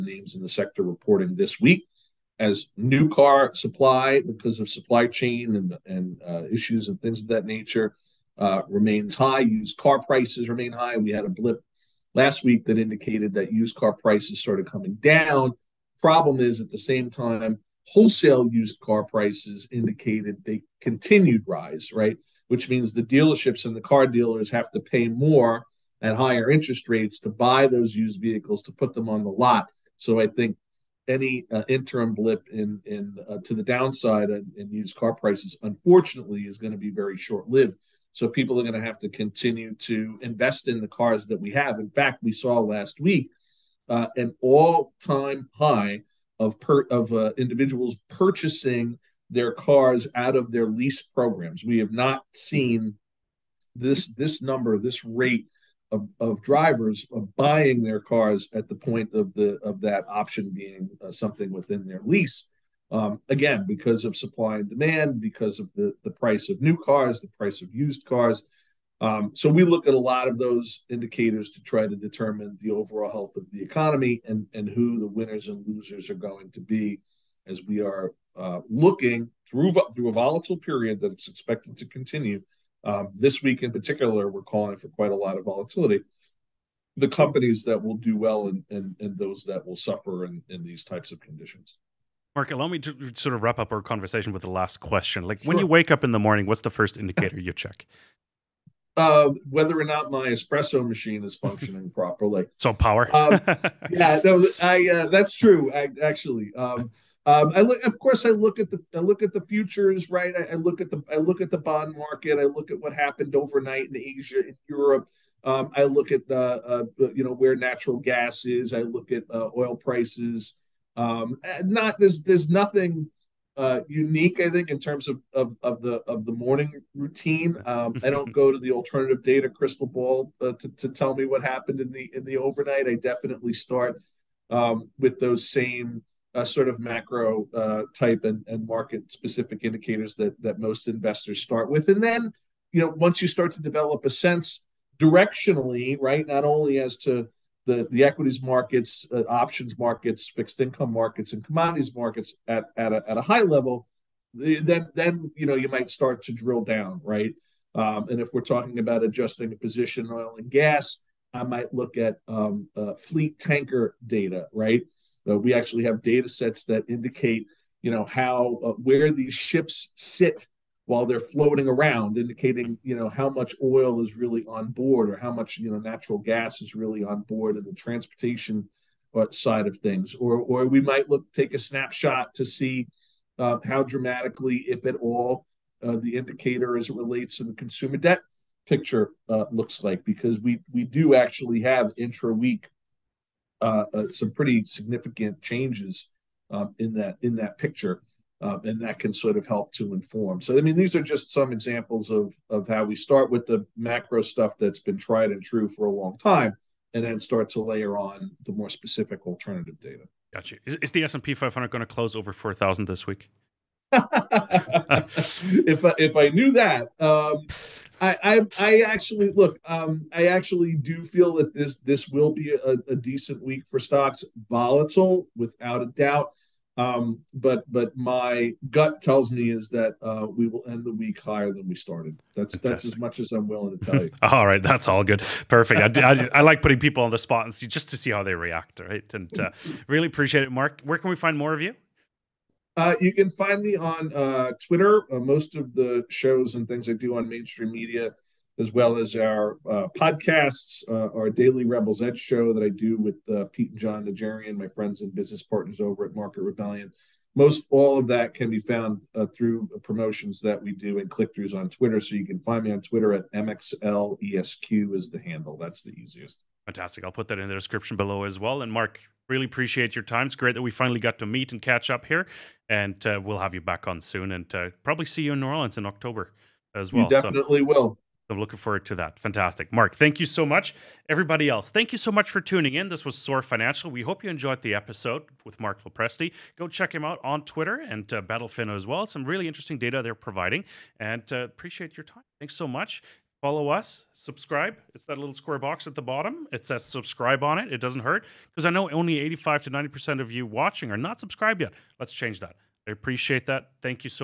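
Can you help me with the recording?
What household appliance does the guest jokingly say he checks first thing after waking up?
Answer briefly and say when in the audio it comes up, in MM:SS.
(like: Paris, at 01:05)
Espresso machine, at 01:40.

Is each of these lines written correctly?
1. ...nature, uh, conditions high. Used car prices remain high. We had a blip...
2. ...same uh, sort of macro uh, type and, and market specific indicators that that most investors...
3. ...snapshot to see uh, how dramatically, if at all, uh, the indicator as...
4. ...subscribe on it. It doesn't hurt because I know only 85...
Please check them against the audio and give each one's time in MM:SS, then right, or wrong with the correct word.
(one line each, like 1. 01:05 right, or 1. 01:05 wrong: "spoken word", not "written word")
1. 00:07 wrong: "remains", not "conditions"
2. 02:15 right
3. 03:01 right
4. 04:56 right.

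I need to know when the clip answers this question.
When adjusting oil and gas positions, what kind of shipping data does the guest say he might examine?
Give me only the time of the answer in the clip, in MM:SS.
02:42.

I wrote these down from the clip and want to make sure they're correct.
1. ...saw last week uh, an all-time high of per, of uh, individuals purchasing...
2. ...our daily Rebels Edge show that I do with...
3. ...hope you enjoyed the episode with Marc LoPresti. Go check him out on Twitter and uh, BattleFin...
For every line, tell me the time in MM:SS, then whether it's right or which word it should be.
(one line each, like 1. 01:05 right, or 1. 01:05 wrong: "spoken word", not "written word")
1. 00:42 right
2. 04:11 right
3. 04:44 right.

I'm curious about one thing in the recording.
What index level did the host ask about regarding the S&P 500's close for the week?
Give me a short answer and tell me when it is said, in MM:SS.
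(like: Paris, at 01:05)
4,000, at 03:32.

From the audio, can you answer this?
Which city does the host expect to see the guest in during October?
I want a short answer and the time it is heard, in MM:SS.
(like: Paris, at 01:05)
New Orleans, at 04:35.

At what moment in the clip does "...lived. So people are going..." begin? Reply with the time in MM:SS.
00:37.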